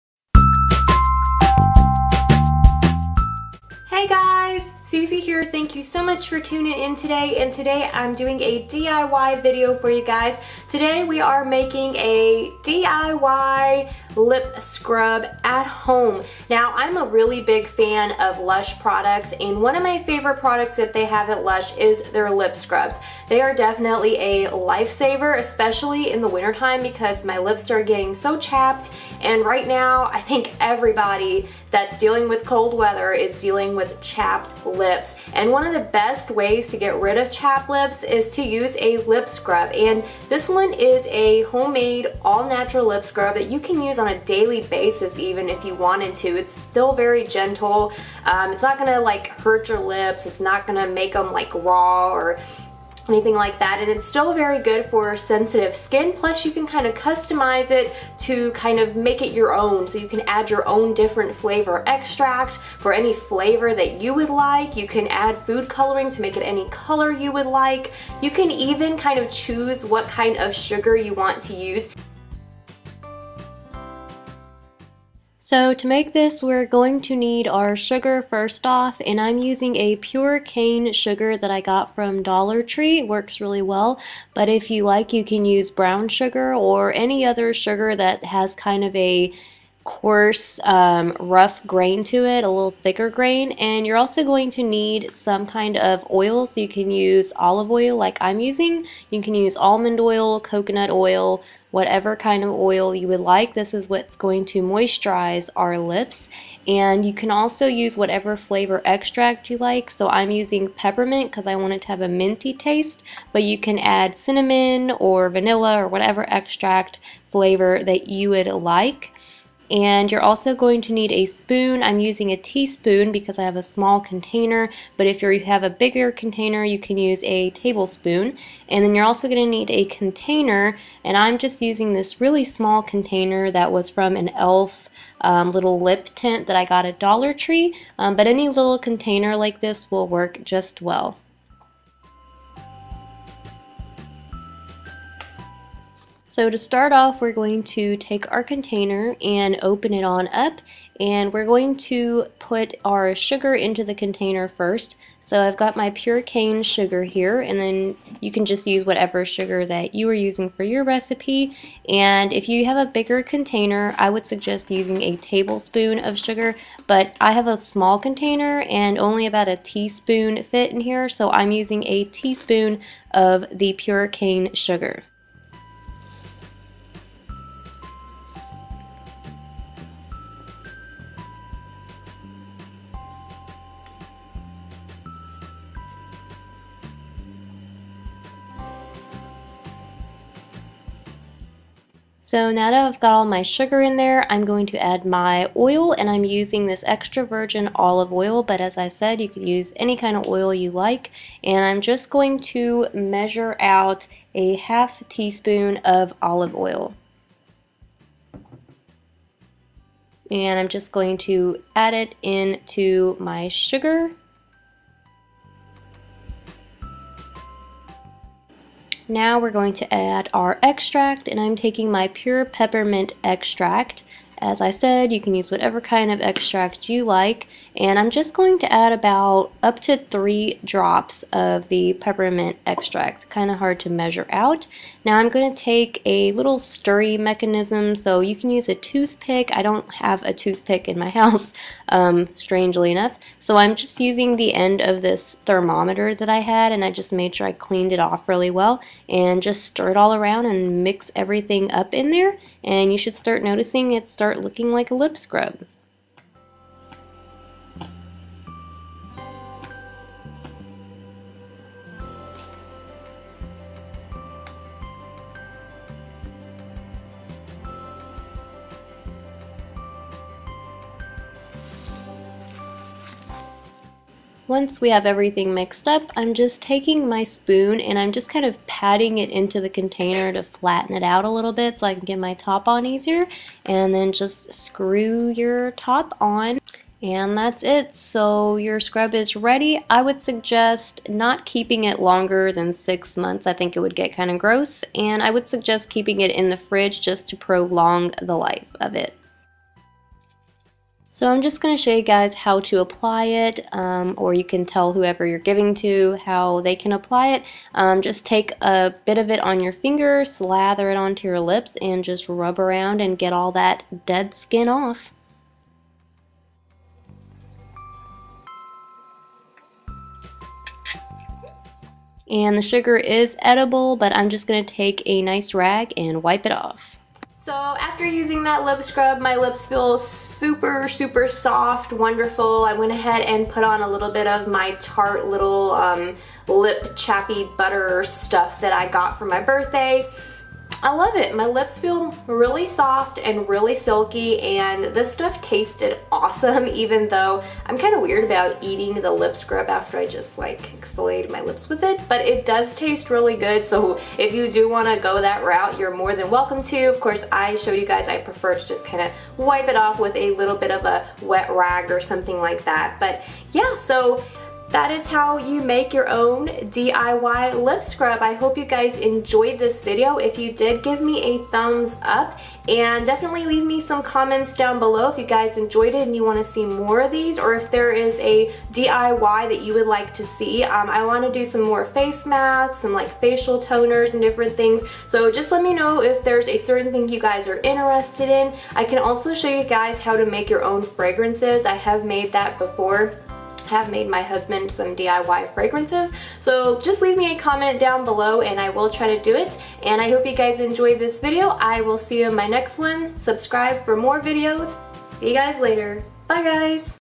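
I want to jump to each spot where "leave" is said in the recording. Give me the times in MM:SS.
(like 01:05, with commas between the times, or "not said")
06:13, 06:37.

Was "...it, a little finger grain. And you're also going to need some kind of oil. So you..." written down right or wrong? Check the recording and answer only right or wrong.
wrong.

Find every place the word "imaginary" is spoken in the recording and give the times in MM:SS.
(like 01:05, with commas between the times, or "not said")
not said.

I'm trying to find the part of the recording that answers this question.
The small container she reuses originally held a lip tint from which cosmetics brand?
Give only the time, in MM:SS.
02:14.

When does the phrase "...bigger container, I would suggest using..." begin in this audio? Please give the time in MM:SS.
02:42.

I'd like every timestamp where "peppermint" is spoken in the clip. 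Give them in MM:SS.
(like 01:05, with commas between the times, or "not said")
01:50, 03:42, 03:51.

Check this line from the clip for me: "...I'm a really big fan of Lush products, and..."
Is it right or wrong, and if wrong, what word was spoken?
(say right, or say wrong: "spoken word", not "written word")
right.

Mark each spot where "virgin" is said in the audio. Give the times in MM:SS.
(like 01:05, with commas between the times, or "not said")
03:17.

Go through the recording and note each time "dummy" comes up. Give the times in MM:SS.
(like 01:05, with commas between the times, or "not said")
not said.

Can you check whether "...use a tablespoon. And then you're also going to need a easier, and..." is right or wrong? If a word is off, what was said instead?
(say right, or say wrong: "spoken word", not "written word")
wrong: "container", not "easier".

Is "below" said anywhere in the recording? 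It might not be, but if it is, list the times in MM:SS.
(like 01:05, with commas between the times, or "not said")
06:14, 06:38.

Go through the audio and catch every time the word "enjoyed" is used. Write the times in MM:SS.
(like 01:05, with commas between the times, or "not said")
06:08, 06:15, 06:40.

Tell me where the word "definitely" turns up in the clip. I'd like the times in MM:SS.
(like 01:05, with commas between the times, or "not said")
00:23, 06:13.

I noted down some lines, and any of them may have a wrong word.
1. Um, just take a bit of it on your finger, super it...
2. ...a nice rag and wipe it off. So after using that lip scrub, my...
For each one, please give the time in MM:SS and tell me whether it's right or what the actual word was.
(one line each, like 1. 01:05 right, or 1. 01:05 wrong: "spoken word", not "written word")
1. 05:07 wrong: "slather", not "super"
2. 05:25 right.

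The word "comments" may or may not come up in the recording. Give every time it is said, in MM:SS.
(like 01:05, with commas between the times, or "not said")
06:14, 06:37.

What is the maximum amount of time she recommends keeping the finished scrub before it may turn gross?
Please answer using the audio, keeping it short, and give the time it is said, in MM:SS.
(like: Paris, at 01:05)
6 months, at 04:52.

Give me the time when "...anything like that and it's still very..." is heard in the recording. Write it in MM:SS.
00:53.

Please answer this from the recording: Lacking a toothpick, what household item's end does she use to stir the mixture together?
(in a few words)
thermometer.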